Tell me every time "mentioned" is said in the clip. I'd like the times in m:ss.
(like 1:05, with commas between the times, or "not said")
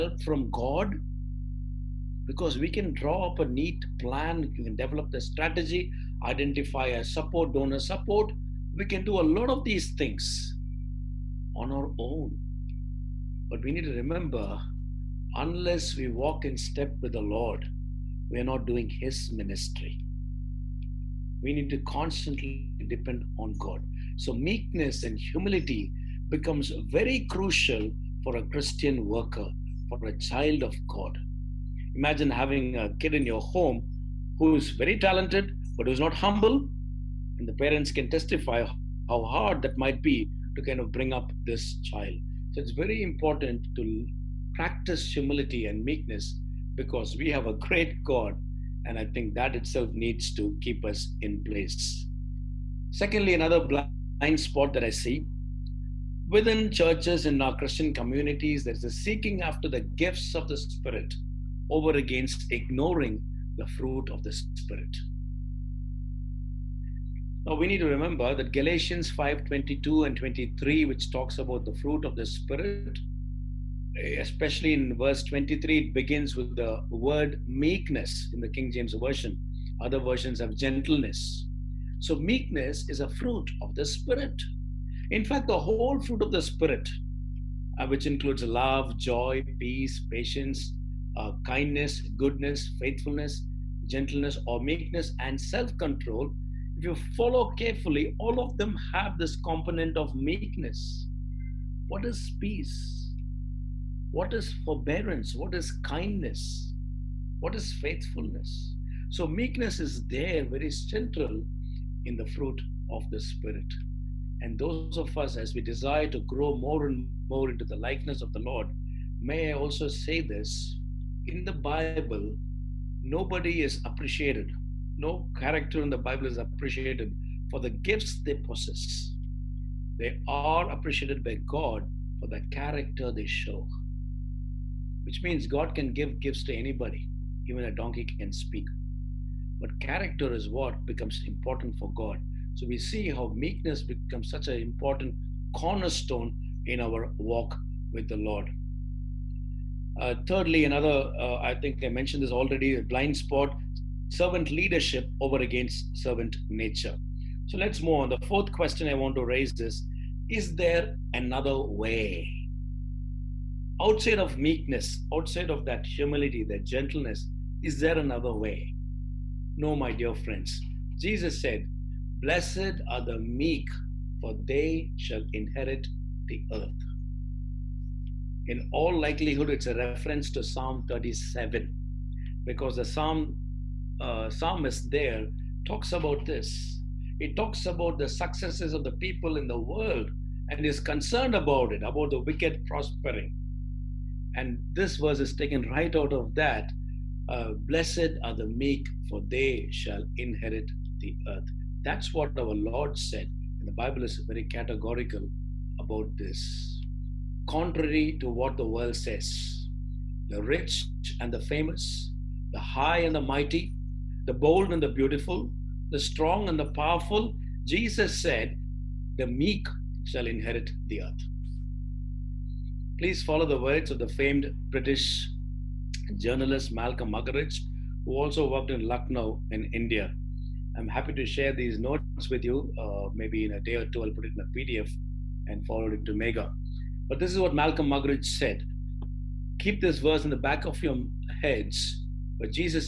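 2:31.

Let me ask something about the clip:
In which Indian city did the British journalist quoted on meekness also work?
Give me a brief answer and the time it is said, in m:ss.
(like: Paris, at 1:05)
Lucknow, at 3:48.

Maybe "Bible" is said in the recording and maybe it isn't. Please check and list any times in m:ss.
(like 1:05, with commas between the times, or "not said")
2:01, 2:05, 3:23.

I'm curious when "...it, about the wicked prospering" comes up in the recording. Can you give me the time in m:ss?
3:11.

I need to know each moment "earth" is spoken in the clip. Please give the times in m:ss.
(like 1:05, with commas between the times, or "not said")
2:56, 3:21, 3:41.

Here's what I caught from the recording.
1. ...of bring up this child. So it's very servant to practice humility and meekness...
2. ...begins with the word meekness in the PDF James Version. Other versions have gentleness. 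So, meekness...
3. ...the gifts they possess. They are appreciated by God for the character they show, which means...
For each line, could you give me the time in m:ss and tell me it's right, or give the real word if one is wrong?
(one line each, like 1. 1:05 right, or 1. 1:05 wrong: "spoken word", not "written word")
1. 0:40 wrong: "important", not "servant"
2. 1:15 wrong: "King", not "PDF"
3. 2:07 right.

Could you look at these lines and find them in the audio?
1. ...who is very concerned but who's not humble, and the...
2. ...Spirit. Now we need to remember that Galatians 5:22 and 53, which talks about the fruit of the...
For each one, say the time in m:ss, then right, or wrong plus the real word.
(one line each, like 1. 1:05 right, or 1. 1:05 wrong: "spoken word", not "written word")
1. 0:34 wrong: "talented", not "concerned"
2. 1:04 wrong: "23", not "53".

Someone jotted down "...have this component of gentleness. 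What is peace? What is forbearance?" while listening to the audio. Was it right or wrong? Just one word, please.
wrong.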